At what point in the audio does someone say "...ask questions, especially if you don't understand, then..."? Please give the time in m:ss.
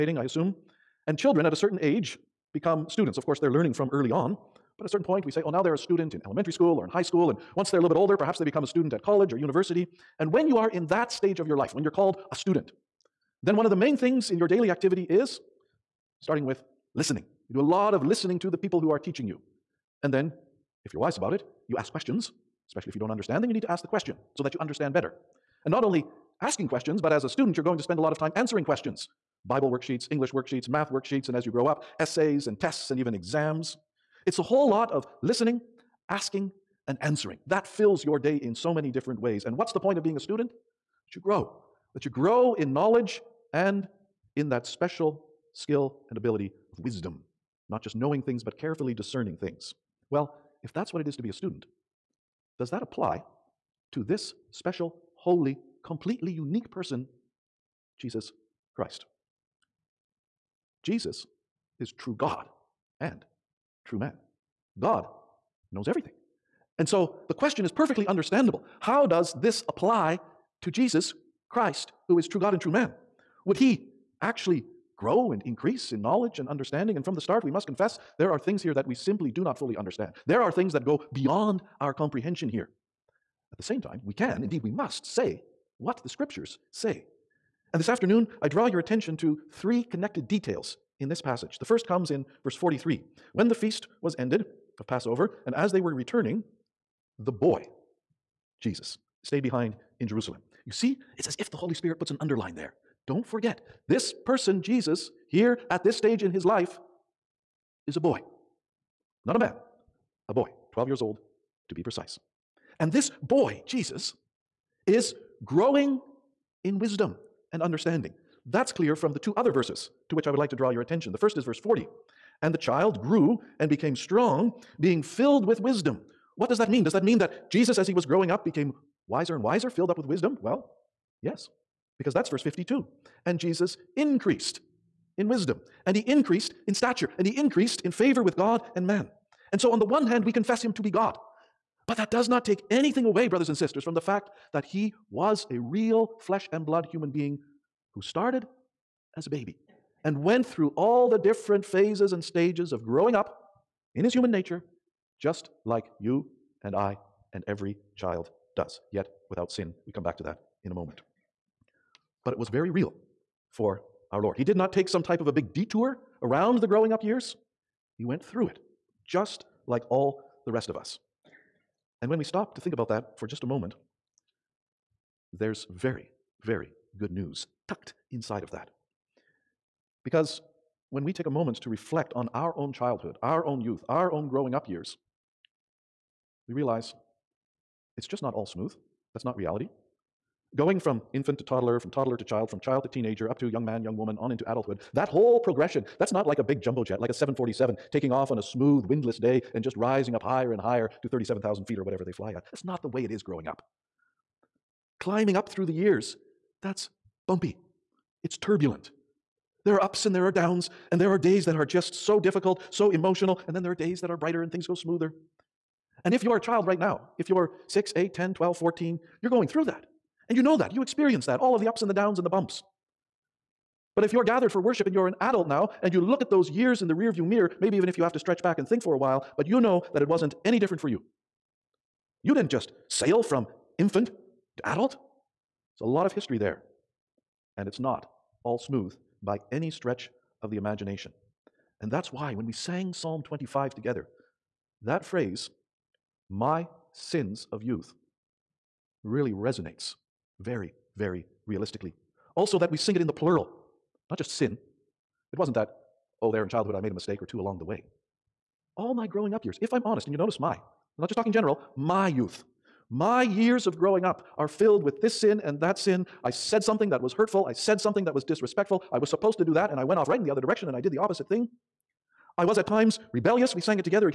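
0:21.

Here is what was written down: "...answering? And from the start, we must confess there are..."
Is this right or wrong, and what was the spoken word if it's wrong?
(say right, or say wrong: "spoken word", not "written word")
wrong: "understanding", not "answering".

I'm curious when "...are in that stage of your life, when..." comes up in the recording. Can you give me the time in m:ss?
0:10.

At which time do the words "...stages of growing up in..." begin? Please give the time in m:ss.
2:32.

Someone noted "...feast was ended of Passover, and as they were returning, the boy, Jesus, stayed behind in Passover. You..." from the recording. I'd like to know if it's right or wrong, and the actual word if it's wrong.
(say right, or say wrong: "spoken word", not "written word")
wrong: "Jerusalem", not "Passover".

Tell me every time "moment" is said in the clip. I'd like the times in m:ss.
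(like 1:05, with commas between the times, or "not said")
2:40, 2:53, 3:01.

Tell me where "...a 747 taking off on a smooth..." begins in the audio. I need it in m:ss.
3:17.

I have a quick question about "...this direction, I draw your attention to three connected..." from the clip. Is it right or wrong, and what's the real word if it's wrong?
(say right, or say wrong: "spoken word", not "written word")
wrong: "afternoon", not "direction".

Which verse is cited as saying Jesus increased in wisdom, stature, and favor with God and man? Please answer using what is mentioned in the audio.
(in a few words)
Verse 52.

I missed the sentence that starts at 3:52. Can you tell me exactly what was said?
You didn't just sail from infant to adult.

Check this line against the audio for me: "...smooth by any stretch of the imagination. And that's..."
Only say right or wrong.
right.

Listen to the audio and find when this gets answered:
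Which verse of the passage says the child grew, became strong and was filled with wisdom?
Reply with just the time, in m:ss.
2:01.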